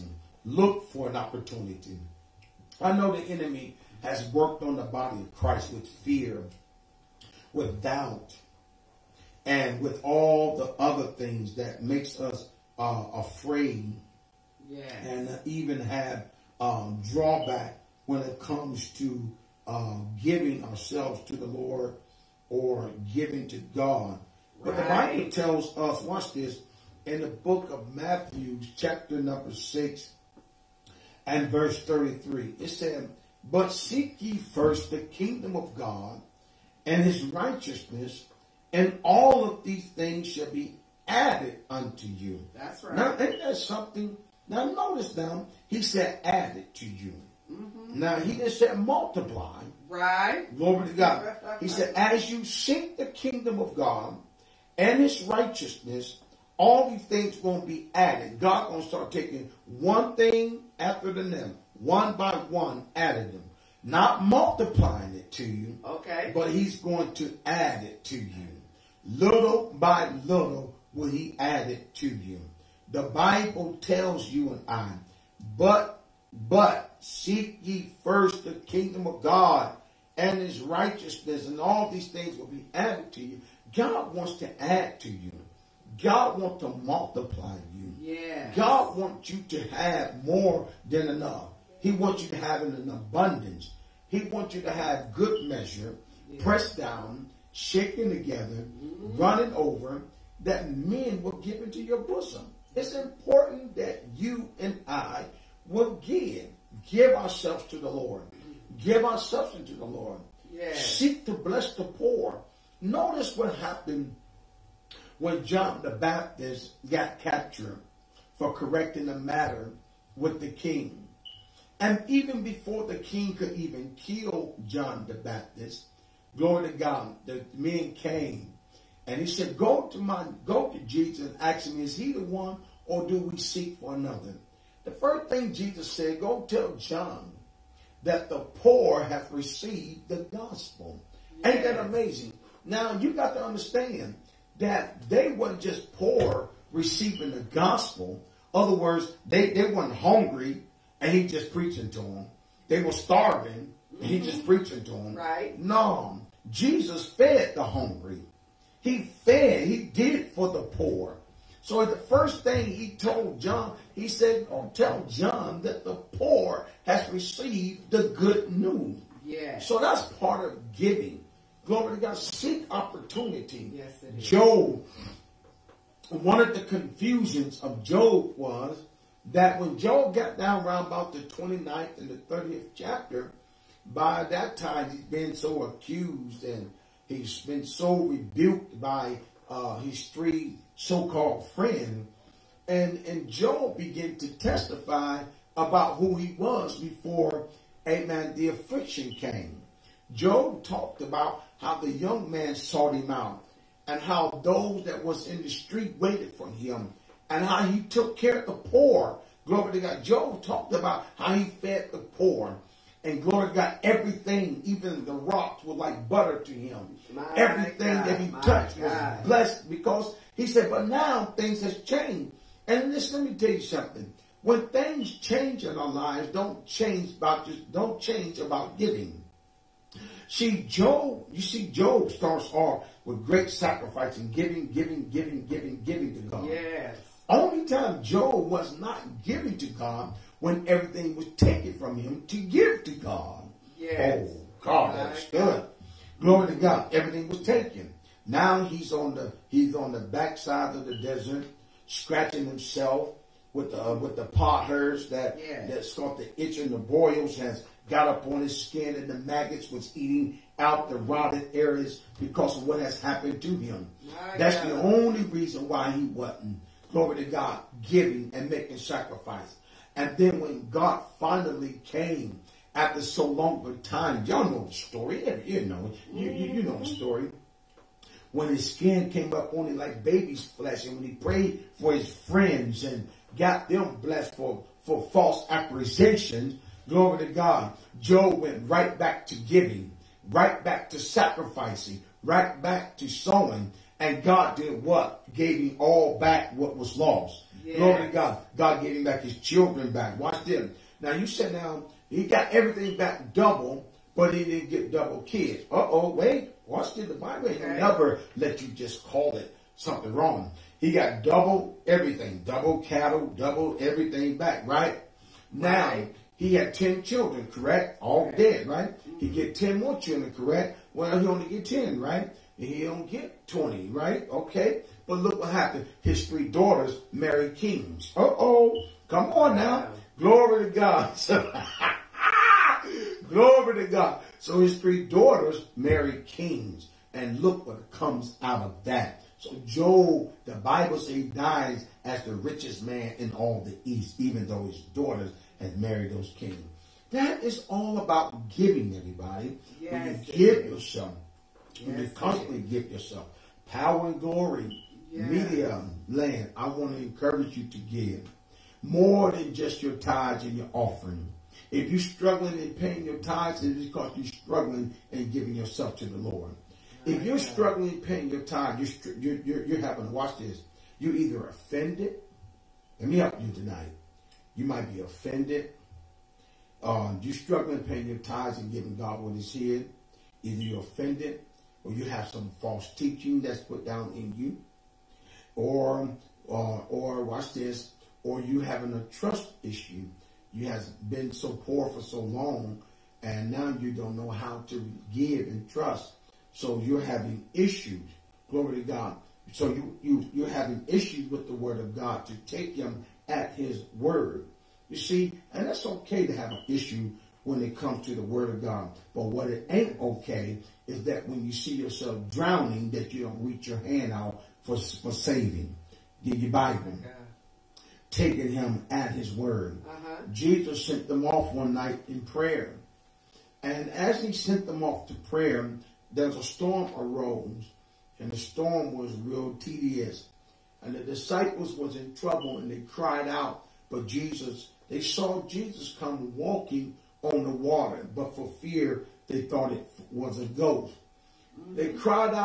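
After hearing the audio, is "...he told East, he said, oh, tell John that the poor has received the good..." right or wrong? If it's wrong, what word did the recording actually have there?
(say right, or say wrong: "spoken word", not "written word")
wrong: "John", not "East".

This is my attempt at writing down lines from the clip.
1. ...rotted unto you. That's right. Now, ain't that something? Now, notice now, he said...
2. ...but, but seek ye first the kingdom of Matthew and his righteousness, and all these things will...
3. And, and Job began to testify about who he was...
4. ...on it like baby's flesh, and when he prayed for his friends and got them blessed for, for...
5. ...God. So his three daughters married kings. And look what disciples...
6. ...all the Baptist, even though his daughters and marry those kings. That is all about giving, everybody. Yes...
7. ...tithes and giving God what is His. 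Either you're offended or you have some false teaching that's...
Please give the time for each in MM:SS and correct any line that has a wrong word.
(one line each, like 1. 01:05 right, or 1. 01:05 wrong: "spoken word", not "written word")
1. 00:41 wrong: "added", not "rotted"
2. 01:15 wrong: "God", not "Matthew"
3. 03:12 right
4. 04:39 right
5. 05:33 wrong: "comes", not "disciples"
6. 05:43 wrong: "East", not "Baptist"
7. 06:18 right.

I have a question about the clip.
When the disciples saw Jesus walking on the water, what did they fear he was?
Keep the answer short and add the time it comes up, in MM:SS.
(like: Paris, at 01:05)
a ghost, at 07:20.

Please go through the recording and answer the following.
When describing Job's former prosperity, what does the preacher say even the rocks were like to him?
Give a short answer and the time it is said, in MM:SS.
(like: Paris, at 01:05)
butter, at 03:36.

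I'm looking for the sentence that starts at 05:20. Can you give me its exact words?
Well, he only get 10, right?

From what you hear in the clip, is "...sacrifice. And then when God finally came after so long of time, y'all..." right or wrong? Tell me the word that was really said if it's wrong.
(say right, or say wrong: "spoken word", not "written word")
right.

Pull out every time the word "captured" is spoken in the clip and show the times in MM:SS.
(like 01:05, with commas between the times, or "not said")
01:57.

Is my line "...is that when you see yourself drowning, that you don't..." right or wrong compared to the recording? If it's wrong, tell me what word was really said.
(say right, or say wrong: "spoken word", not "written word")
right.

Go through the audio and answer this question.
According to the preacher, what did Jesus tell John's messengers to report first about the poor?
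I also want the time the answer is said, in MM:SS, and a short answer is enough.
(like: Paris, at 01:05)
received the gospel, at 02:18.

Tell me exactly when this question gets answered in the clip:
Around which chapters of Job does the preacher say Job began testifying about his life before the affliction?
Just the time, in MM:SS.
03:01.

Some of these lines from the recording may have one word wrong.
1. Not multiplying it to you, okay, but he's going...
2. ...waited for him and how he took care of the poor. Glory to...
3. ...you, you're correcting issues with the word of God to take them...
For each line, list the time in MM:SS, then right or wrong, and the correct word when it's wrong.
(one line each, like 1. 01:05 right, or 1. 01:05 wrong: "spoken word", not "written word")
1. 01:03 right
2. 03:25 right
3. 06:40 wrong: "having", not "correcting".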